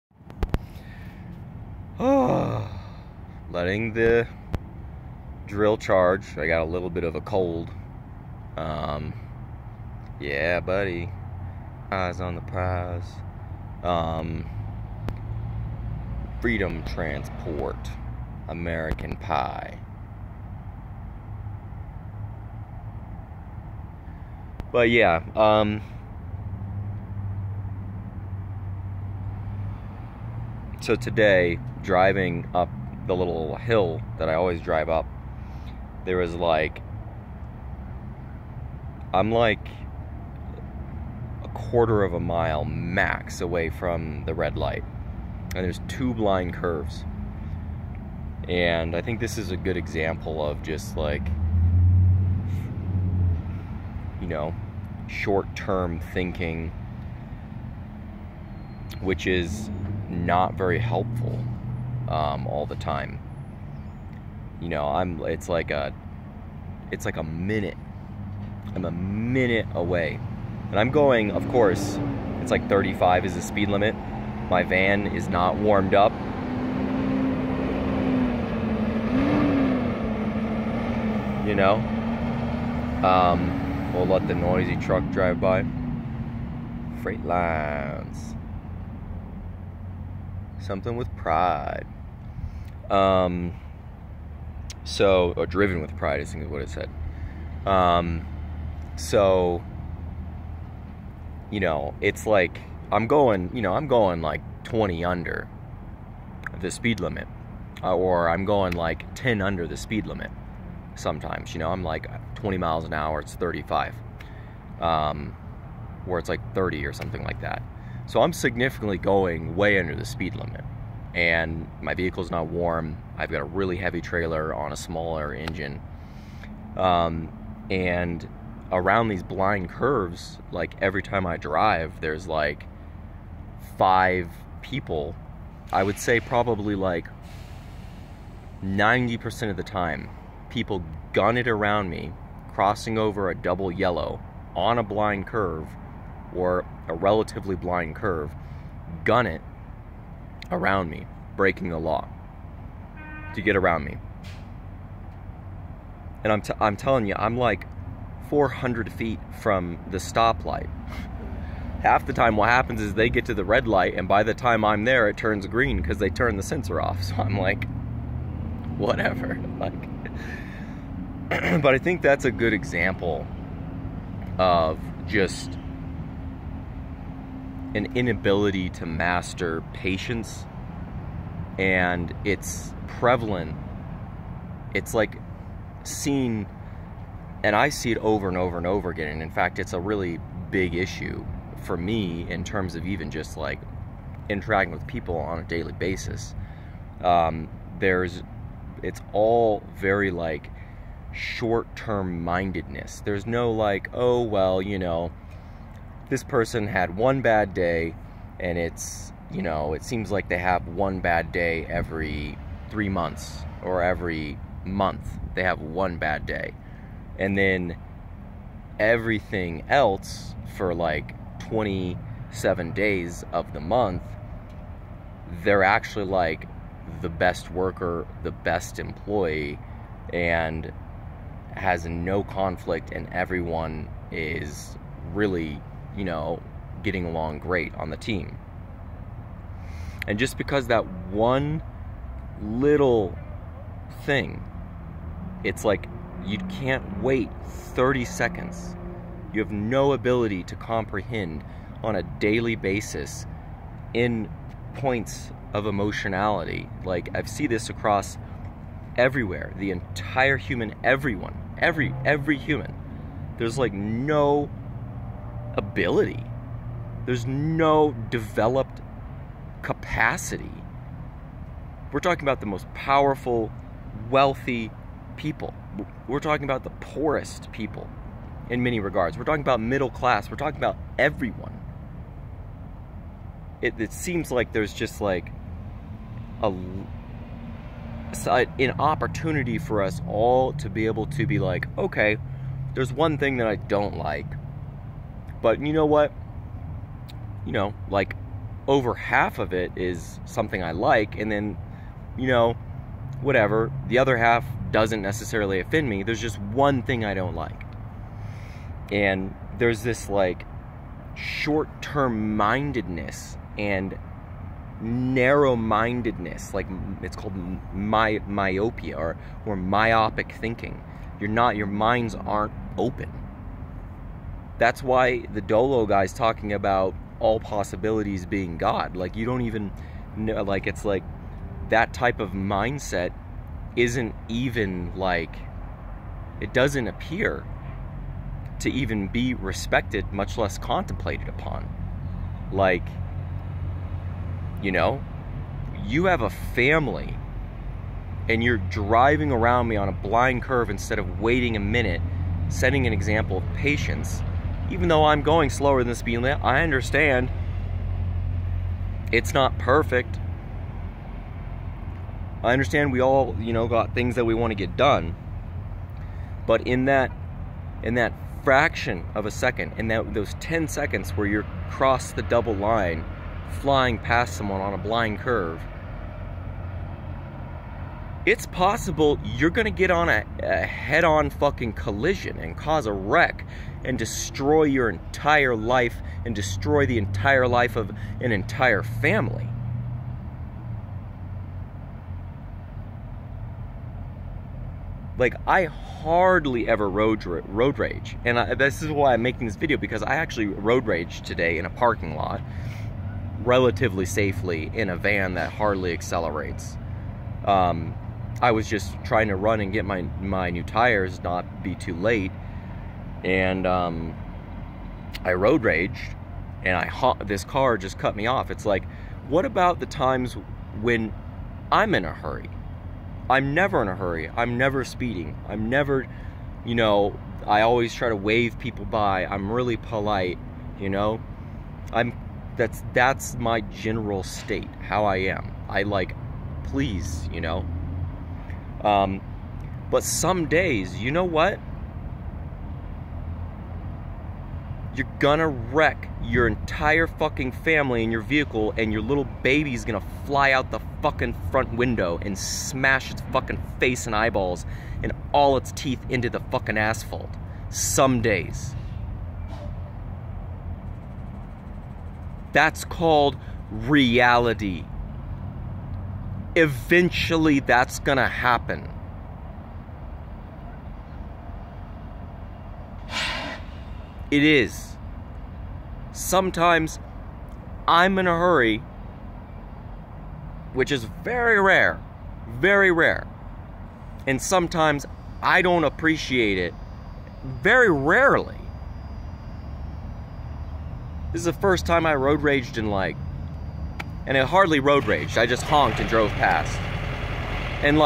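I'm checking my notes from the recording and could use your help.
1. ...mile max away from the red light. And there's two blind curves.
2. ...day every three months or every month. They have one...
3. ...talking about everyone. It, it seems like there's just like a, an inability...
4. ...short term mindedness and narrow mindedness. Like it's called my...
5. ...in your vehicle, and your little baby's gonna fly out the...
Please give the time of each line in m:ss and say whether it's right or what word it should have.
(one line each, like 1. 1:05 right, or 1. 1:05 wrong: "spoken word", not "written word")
1. 0:42 right
2. 3:31 right
3. 4:40 wrong: "opportunity", not "inability"
4. 5:11 right
5. 7:28 right.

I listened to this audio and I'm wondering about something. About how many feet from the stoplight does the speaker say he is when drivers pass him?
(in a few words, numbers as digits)
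400 feet.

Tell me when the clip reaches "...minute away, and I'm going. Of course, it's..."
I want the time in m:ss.
1:08.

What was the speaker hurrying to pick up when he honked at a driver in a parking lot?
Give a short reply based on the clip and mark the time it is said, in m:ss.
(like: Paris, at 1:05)
new tires, at 6:50.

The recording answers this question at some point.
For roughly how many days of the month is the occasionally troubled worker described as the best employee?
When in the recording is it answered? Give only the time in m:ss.
3:41.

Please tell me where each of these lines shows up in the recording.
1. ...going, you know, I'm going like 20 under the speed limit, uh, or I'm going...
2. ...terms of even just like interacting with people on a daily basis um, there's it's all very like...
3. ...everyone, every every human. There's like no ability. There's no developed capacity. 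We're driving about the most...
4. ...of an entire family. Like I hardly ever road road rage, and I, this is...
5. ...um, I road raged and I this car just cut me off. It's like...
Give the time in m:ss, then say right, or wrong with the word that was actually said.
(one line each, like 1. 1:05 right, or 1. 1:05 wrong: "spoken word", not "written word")
1. 1:43 right
2. 3:12 right
3. 4:20 wrong: "talking", not "driving"
4. 6:27 right
5. 6:53 right.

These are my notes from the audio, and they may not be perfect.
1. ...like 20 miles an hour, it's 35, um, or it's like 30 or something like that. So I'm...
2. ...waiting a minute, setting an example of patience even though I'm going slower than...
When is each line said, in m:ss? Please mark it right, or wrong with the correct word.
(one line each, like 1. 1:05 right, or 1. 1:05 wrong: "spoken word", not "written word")
1. 1:51 right
2. 5:51 right.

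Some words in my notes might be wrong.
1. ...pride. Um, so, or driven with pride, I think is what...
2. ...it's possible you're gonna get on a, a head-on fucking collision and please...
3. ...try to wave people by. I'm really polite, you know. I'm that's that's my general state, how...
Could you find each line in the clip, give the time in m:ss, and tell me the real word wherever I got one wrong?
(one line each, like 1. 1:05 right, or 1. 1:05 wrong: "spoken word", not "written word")
1. 1:31 right
2. 6:18 wrong: "cause", not "please"
3. 7:07 right.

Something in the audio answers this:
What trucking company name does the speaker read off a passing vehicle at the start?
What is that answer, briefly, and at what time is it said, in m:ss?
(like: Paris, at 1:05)
Freedom Transport, at 0:16.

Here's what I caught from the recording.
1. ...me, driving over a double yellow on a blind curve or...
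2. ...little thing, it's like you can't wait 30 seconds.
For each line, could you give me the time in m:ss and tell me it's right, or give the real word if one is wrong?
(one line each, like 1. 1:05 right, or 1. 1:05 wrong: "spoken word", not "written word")
1. 2:21 wrong: "crossing", not "driving"
2. 4:02 right.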